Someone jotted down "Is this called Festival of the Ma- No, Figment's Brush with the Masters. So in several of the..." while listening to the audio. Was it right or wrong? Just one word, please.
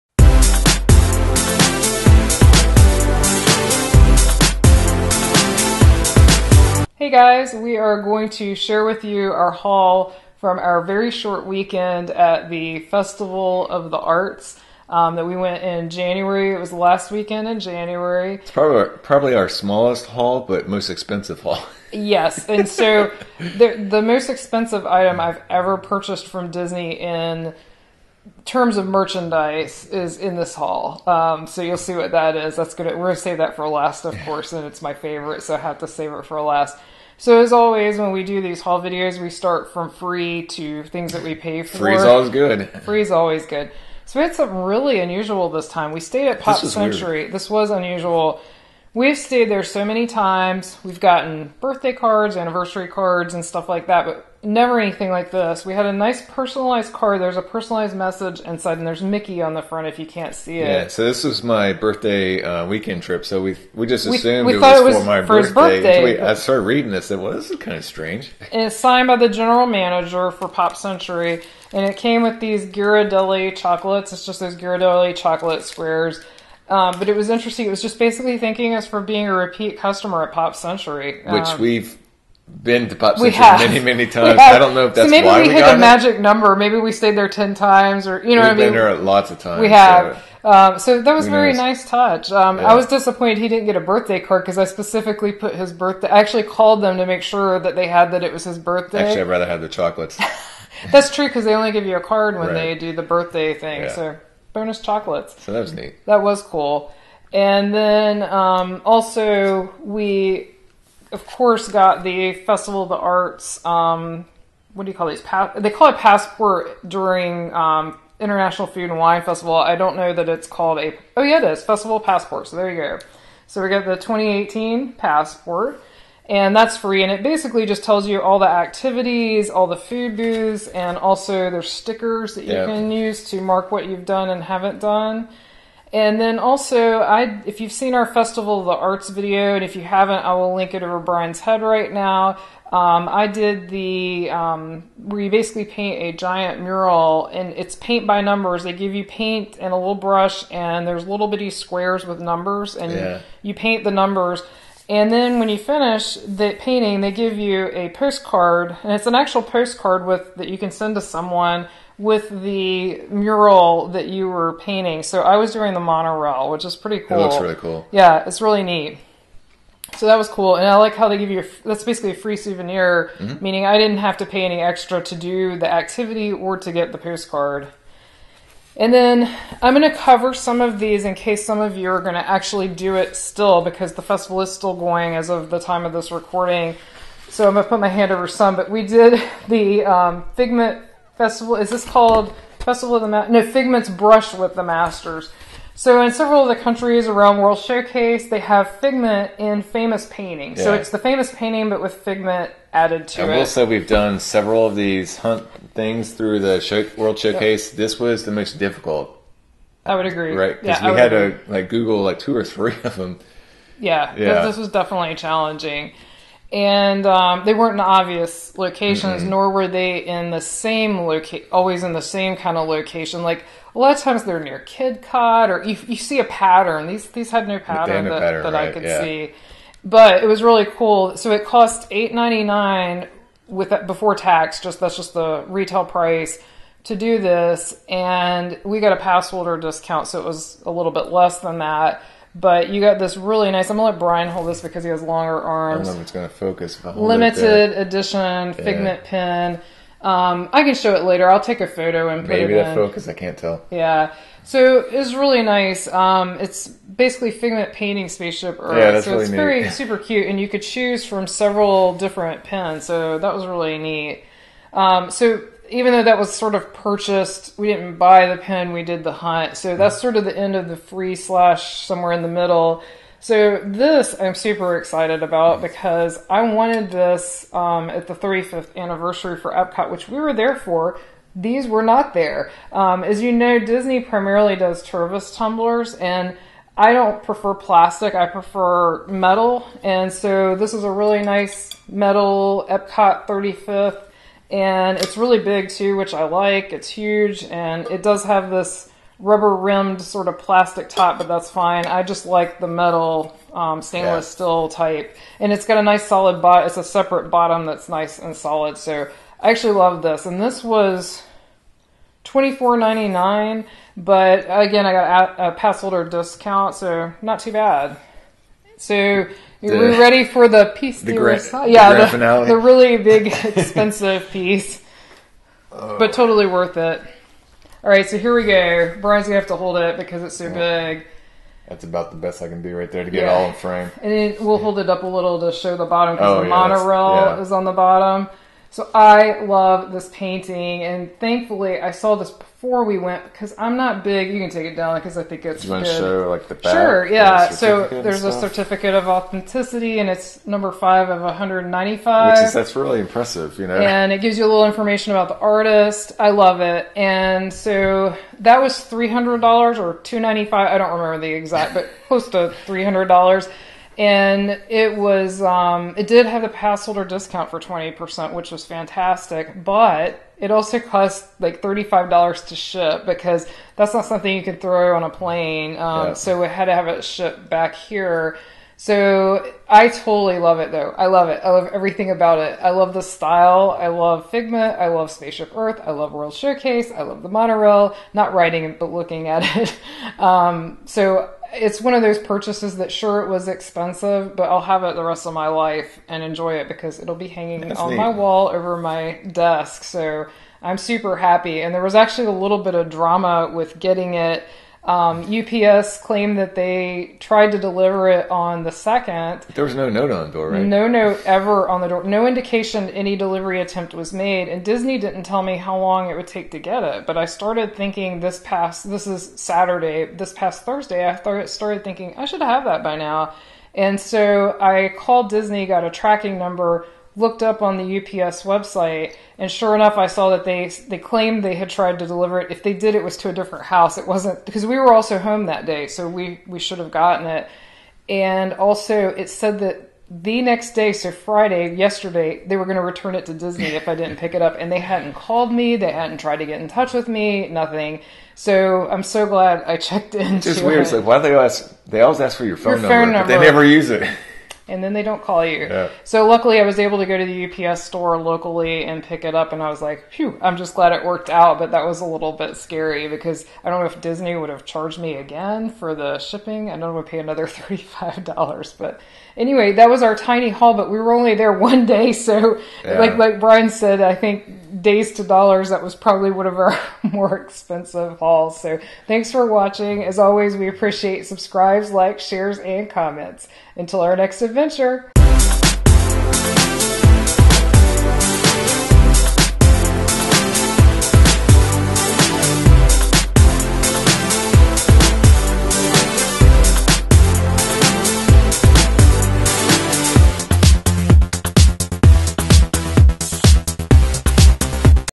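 right.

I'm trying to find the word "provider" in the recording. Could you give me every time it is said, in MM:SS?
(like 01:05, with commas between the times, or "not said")
not said.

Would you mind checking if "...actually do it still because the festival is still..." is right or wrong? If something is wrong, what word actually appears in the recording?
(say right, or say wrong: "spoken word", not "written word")
right.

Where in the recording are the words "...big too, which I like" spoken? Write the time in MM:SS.
04:55.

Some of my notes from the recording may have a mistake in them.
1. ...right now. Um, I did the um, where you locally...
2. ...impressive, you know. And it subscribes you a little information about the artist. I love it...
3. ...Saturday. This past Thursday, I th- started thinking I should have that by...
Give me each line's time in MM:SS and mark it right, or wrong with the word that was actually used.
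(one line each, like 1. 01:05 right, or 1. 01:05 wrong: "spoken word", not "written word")
1. 02:21 wrong: "basically", not "locally"
2. 05:52 wrong: "gives", not "subscribes"
3. 06:59 right.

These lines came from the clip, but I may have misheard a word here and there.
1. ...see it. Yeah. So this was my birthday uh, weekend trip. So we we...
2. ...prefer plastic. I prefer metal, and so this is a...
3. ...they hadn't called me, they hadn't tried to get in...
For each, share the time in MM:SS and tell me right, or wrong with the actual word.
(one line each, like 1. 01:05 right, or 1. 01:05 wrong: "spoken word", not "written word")
1. 01:00 right
2. 04:47 right
3. 07:24 right.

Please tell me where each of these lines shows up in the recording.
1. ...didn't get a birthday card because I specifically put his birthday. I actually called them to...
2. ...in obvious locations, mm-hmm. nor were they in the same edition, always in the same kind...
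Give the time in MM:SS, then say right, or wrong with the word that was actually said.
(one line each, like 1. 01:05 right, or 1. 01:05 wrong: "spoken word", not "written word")
1. 01:33 right
2. 03:37 wrong: "location", not "edition".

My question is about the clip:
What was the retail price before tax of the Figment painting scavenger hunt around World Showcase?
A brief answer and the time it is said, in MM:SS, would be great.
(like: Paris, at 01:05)
$8.99, at 03:51.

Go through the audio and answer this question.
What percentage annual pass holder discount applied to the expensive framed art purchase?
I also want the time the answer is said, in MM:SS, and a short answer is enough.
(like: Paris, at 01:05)
20%, at 06:07.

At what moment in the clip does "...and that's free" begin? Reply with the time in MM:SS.
02:06.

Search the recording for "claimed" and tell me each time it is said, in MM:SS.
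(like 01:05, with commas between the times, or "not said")
06:46, 07:10.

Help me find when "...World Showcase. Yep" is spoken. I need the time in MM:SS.
03:26.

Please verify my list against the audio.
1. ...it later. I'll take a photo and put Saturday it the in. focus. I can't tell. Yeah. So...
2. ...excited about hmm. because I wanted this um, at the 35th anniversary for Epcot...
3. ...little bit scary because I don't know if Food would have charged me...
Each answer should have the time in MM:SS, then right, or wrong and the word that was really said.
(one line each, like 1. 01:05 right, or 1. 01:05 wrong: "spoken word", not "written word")
1. 04:10 wrong: "Maybe", not "Saturday"
2. 04:34 right
3. 07:42 wrong: "Disney", not "Food".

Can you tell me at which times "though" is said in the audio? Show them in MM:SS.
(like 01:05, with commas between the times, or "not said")
04:25, 06:20.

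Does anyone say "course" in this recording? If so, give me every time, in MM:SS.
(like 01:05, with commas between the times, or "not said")
00:34, 01:51.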